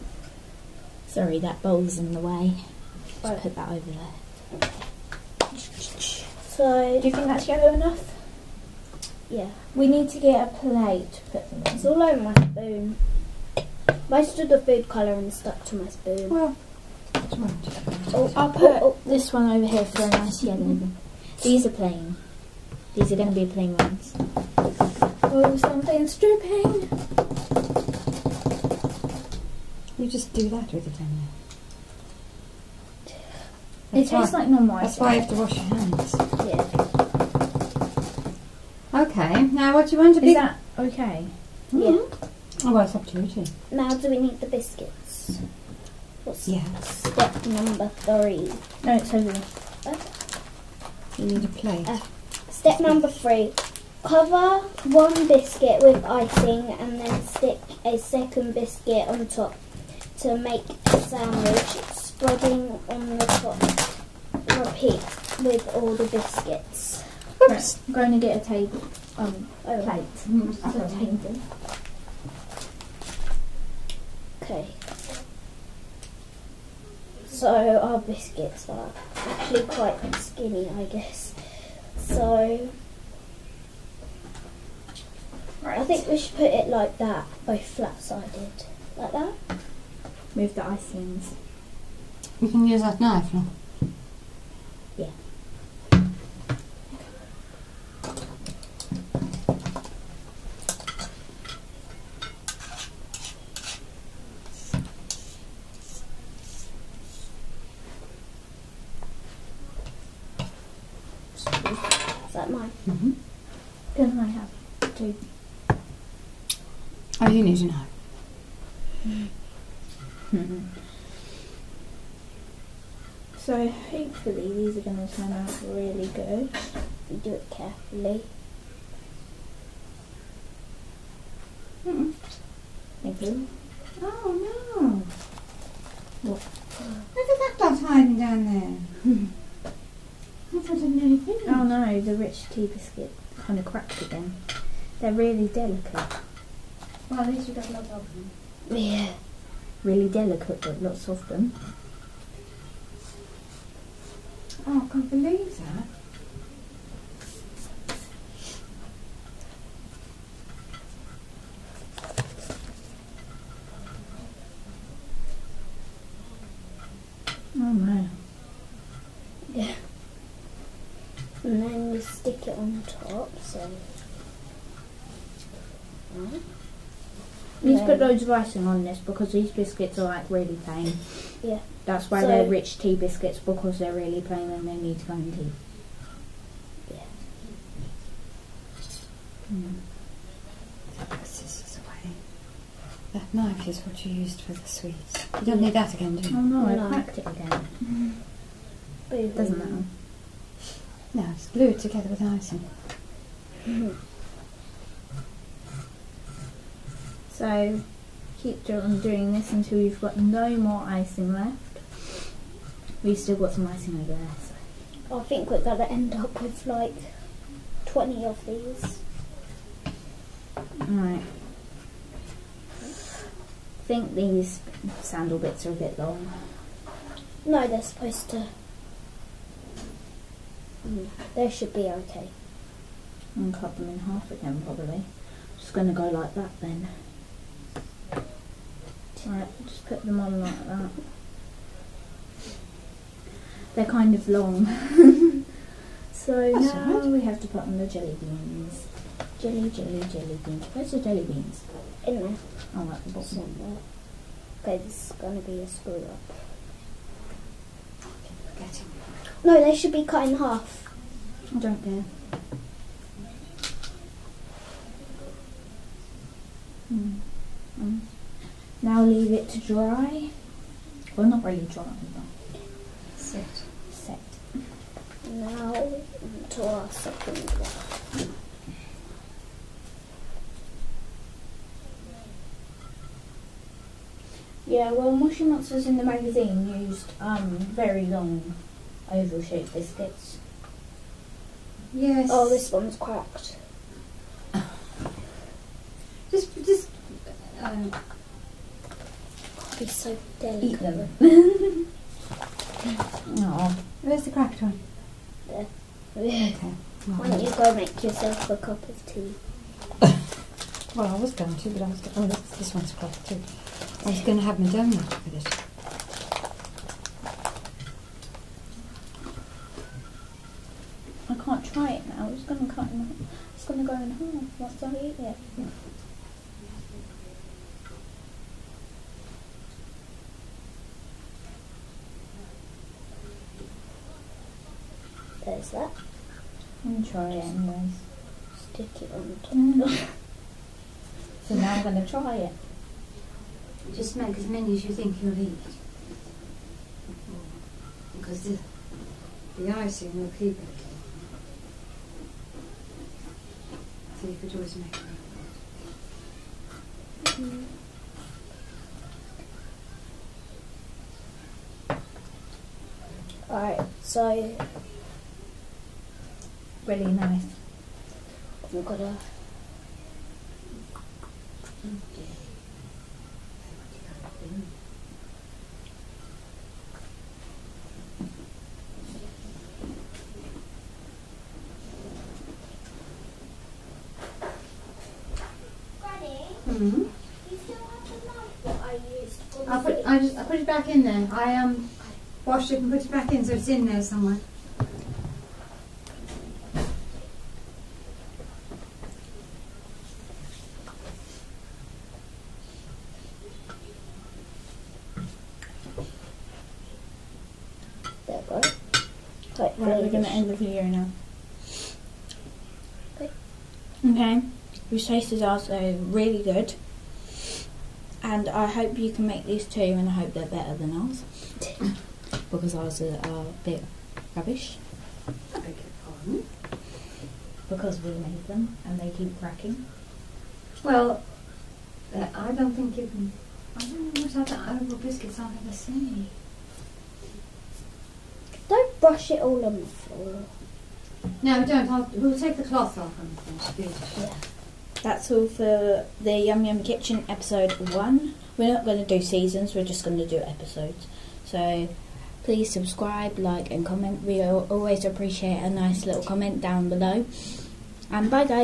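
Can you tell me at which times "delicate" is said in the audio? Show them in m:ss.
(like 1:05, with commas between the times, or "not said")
2:25, 2:30, 5:00.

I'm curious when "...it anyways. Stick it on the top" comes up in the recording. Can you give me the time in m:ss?
5:37.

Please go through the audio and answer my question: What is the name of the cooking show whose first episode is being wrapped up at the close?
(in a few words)
Yum Yum Kitchen.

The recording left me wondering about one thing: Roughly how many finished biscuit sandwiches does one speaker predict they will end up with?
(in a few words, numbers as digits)
20.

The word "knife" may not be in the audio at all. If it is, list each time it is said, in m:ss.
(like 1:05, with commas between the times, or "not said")
1:32, 3:13.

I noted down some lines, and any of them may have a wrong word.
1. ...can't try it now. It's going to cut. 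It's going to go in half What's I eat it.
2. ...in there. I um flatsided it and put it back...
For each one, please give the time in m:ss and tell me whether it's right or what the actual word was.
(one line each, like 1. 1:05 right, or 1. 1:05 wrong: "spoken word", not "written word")
1. 5:21 right
2. 6:30 wrong: "washed", not "flatsided".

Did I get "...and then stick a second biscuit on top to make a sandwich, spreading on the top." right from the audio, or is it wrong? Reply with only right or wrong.
right.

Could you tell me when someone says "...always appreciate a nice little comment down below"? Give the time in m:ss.
7:34.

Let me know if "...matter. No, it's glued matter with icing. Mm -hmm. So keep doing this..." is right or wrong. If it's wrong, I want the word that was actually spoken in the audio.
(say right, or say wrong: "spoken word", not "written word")
wrong: "together", not "matter".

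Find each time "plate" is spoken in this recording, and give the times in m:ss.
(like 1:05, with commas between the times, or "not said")
0:10, 0:51, 1:09.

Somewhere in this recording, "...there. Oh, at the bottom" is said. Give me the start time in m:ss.
4:12.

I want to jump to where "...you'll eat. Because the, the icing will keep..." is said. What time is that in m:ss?
5:45.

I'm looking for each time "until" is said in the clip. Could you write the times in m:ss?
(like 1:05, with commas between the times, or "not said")
3:29.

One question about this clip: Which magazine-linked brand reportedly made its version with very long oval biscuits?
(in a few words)
Moshi Monsters.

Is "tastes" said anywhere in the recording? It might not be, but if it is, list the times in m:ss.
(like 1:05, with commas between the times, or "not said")
0:34, 6:54.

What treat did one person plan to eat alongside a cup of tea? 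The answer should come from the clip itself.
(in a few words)
donut.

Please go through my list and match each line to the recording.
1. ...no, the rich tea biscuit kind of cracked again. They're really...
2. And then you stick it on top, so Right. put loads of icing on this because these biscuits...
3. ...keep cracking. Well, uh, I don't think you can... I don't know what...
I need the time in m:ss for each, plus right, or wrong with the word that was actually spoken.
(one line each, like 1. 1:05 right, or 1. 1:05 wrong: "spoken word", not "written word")
1. 2:21 right
2. 2:51 right
3. 7:09 right.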